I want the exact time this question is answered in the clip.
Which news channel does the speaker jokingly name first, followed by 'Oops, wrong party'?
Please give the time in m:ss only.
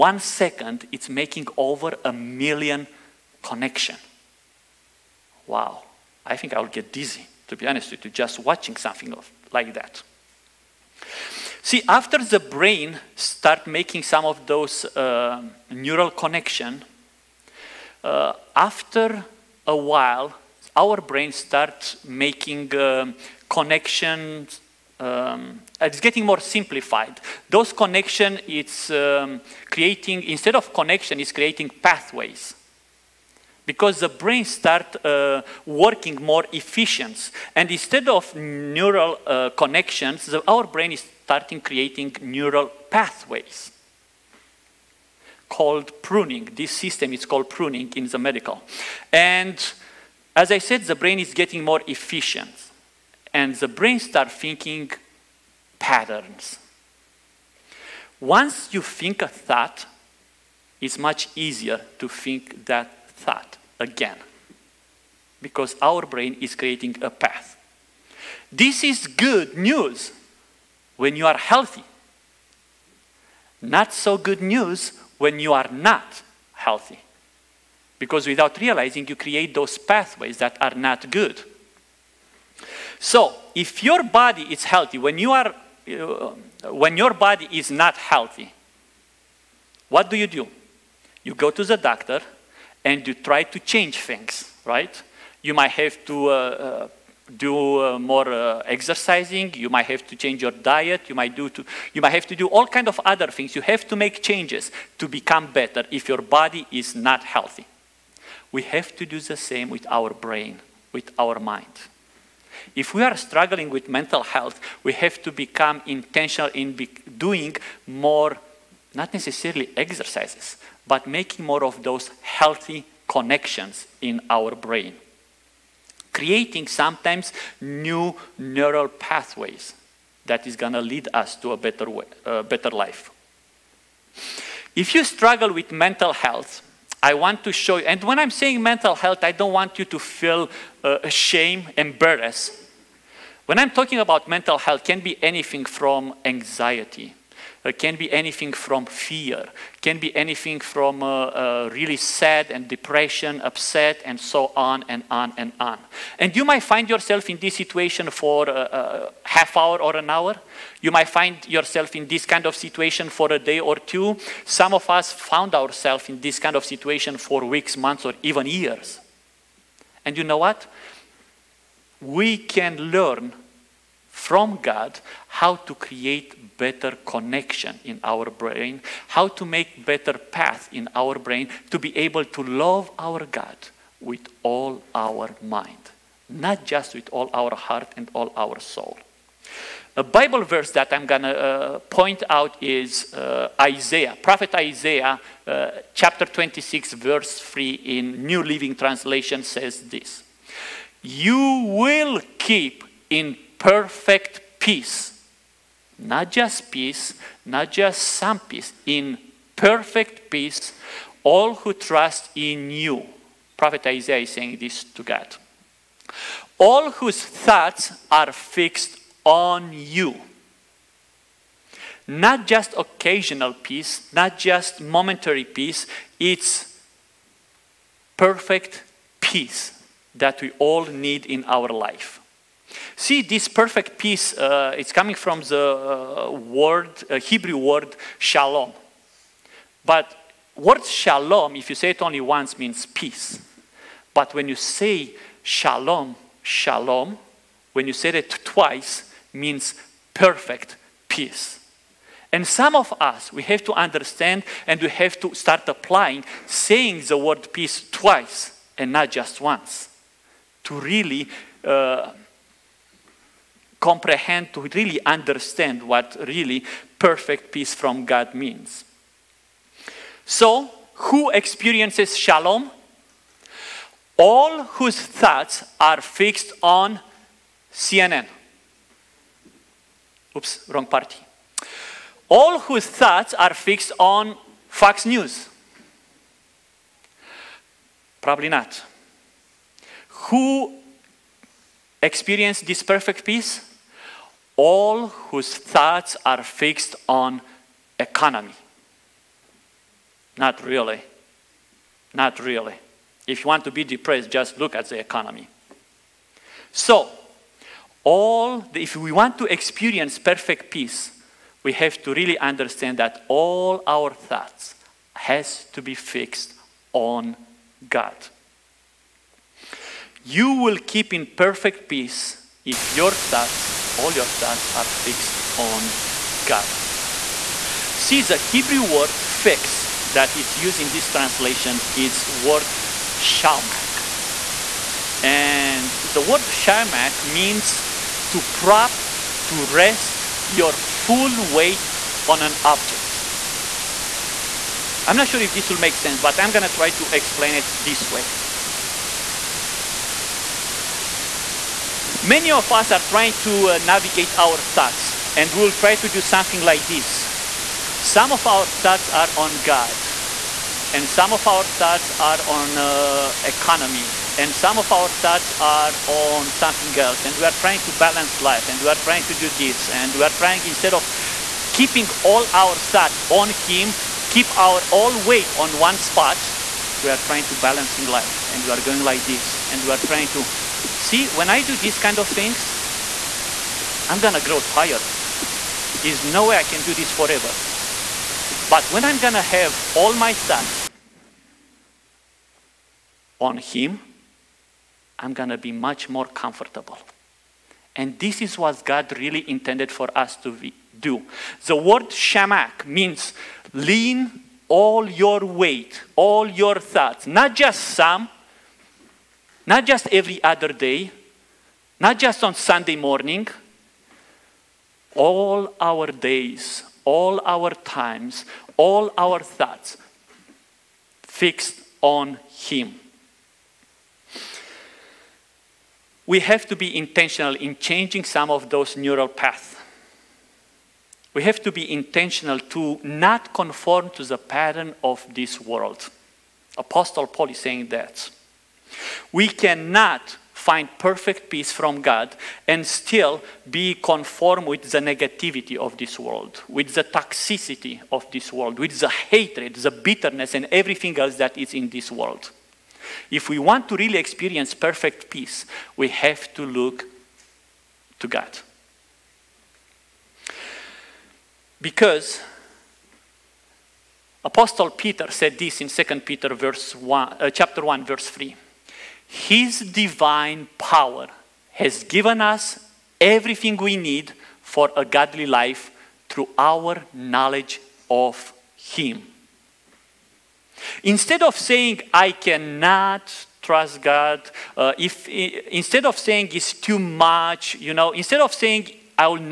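4:37.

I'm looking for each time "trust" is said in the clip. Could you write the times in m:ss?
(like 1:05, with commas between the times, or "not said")
3:31, 8:03.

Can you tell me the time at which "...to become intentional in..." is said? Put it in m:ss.
1:55.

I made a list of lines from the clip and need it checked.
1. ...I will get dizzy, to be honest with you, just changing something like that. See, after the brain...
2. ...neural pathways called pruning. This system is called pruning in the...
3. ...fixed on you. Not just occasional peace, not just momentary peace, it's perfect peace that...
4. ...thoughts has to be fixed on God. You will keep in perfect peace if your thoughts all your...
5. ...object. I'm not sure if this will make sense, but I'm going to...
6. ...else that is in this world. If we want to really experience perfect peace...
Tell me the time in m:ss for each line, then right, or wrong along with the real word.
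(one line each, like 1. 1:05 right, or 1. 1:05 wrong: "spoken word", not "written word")
1. 0:06 wrong: "watching", not "changing"
2. 0:42 right
3. 3:38 right
4. 5:14 right
5. 5:42 right
6. 7:31 right.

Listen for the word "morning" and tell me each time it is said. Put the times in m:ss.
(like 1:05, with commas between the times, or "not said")
6:52.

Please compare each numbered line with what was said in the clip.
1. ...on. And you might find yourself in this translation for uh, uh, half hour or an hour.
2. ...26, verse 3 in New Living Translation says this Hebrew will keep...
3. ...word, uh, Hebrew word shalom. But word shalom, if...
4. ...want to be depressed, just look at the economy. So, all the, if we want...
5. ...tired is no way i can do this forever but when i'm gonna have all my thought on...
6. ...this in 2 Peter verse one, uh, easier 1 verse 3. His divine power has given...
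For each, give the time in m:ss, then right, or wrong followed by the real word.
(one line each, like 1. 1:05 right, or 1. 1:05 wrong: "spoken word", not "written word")
1. 2:35 wrong: "situation", not "translation"
2. 3:16 wrong: "You", not "Hebrew"
3. 3:56 right
4. 5:03 right
5. 6:24 right
6. 7:45 wrong: "chapter", not "easier".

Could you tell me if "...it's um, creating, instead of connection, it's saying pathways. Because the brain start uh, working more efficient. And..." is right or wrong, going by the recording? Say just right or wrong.
wrong.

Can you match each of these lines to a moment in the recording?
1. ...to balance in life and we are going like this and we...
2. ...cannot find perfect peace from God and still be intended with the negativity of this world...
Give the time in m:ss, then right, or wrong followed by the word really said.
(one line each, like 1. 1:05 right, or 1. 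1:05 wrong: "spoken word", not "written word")
1. 6:17 right
2. 7:19 wrong: "conformed", not "intended".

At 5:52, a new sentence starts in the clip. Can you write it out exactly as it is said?
Many of us are trying to uh, navigate our thoughts, and we'll try to do something like this.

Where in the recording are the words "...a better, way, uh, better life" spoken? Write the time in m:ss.
2:11.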